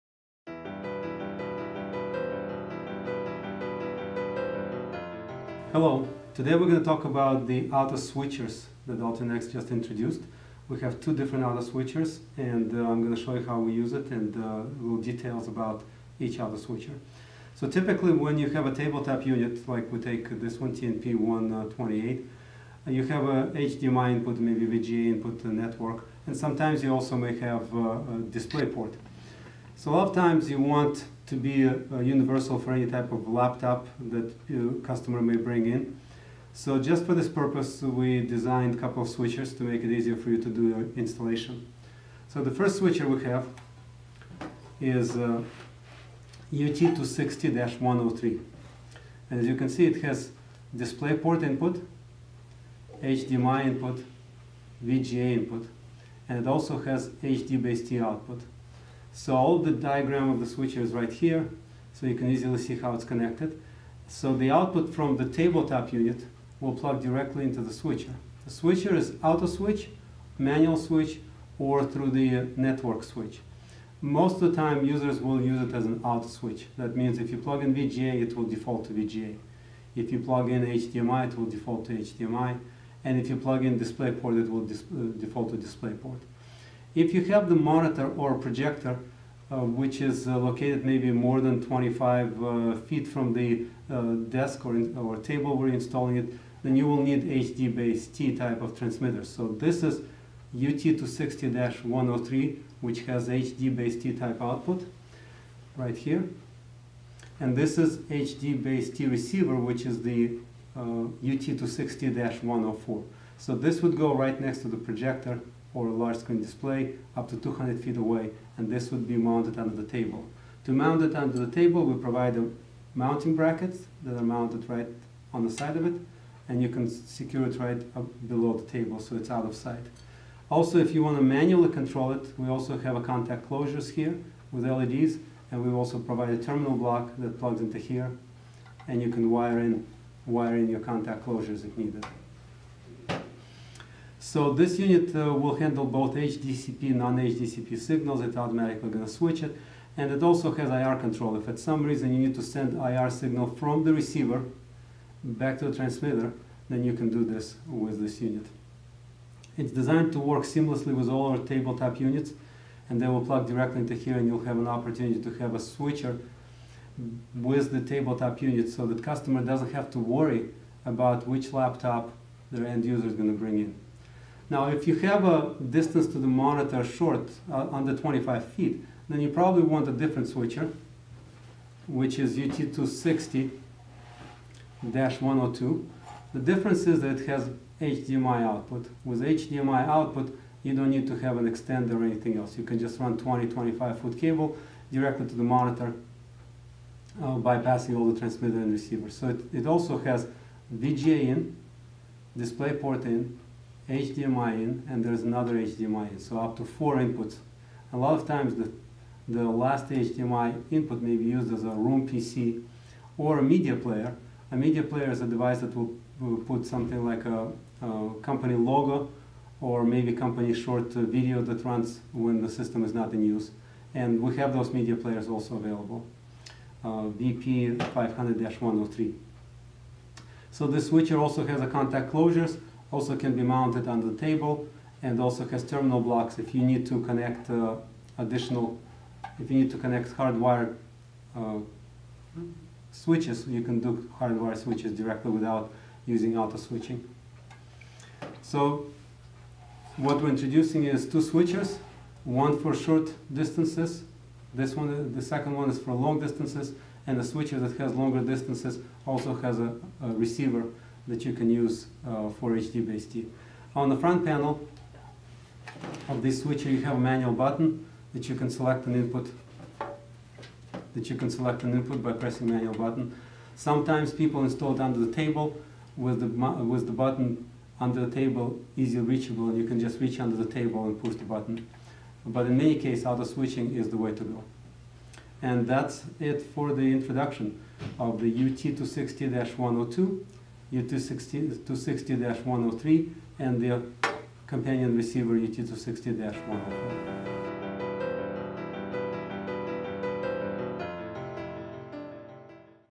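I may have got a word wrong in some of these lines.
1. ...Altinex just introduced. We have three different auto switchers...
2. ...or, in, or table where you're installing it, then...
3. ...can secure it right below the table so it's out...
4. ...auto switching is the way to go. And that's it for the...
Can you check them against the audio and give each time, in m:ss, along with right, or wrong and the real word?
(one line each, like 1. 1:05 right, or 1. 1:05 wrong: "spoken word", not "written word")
1. 0:08 wrong: "two", not "three"
2. 1:34 right
3. 2:06 right
4. 4:43 right.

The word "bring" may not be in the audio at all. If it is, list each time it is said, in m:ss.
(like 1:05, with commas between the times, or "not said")
0:35, 2:53.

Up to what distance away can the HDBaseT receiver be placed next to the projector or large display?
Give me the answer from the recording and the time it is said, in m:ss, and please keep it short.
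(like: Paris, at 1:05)
200 feet, at 1:57.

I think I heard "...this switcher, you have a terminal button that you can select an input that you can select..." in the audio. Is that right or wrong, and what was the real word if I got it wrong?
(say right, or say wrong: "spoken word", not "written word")
wrong: "manual", not "terminal".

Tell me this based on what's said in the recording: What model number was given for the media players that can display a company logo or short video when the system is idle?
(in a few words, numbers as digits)
VP 500-103.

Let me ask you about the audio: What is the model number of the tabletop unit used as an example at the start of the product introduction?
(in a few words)
TNP128.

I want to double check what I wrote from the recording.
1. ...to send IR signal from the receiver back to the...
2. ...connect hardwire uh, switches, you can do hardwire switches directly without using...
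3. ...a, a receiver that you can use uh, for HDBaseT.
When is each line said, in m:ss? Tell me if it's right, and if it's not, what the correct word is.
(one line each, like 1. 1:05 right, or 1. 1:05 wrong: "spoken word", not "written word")
1. 2:32 right
2. 3:59 right
3. 4:19 right.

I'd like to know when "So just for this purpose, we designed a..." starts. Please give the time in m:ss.
0:36.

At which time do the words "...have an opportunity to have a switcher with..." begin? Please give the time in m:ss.
2:44.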